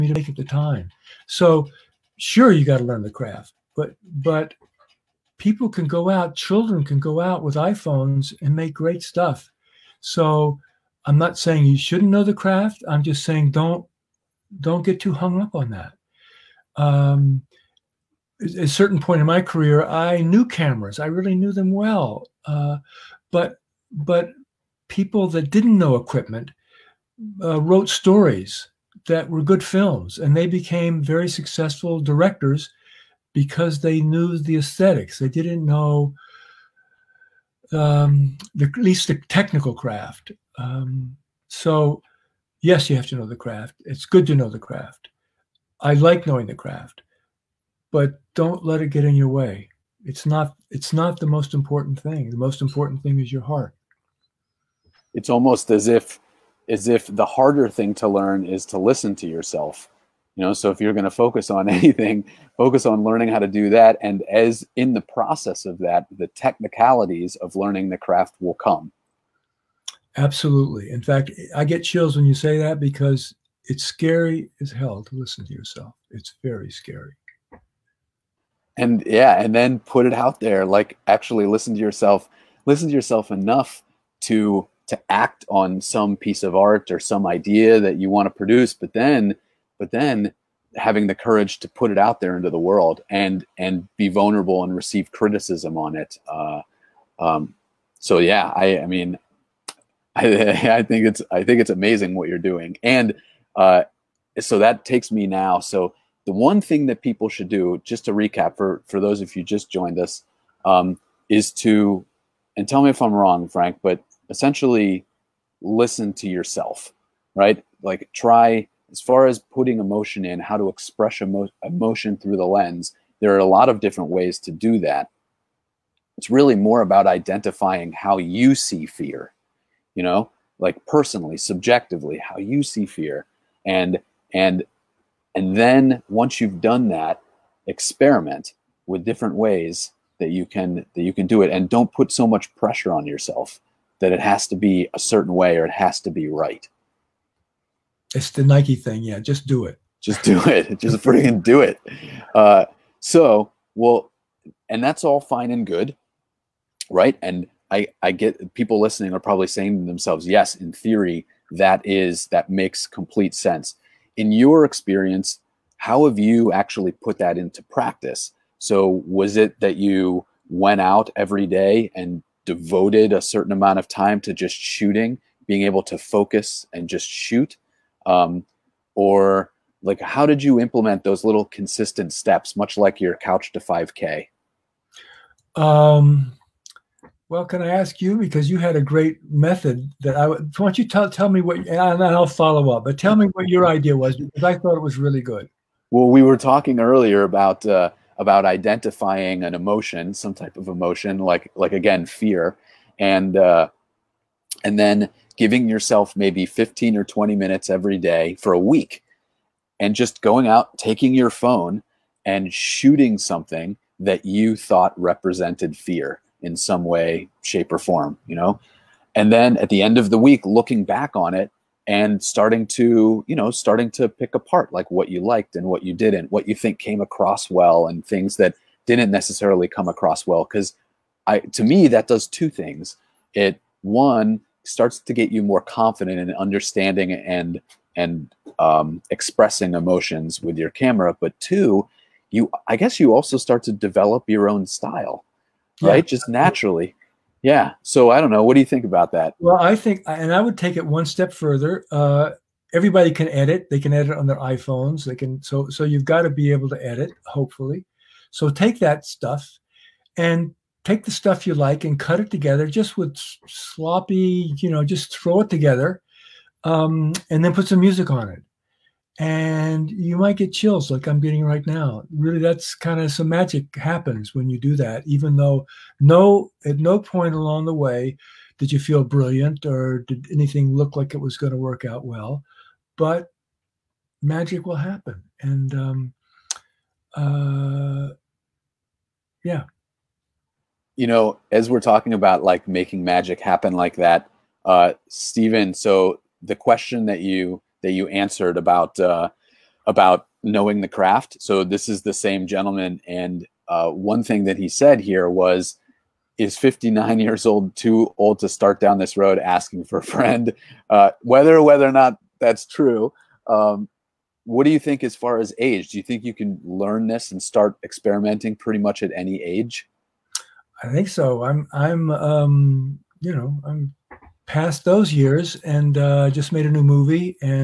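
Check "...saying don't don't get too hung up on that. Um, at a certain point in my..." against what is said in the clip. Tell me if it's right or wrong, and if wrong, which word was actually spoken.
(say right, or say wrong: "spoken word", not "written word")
right.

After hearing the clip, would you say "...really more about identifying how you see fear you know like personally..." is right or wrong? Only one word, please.
right.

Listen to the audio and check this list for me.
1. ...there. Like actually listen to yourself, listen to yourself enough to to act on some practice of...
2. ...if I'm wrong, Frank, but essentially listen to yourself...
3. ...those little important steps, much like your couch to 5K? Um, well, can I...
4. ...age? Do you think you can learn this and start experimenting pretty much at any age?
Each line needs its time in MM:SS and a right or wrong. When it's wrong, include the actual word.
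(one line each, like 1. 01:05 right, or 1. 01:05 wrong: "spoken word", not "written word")
1. 01:20 wrong: "piece", not "practice"
2. 01:52 right
3. 03:01 wrong: "consistent", not "important"
4. 05:15 right.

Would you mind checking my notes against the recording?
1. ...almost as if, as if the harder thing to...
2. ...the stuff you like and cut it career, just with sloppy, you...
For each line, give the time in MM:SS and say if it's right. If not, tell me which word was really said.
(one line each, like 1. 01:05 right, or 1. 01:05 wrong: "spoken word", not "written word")
1. 00:55 right
2. 04:21 wrong: "together", not "career".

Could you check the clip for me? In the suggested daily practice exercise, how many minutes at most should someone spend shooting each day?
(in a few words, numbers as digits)
20.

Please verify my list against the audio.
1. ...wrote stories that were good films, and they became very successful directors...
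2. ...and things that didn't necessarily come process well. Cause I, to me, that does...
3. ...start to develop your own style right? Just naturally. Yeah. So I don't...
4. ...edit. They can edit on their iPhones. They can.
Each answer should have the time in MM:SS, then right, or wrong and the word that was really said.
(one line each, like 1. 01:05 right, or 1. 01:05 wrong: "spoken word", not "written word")
1. 00:27 right
2. 03:47 wrong: "across", not "process"
3. 04:03 right
4. 04:13 right.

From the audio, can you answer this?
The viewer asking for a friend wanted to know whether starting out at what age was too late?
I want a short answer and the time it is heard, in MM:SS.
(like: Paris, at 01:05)
59, at 05:06.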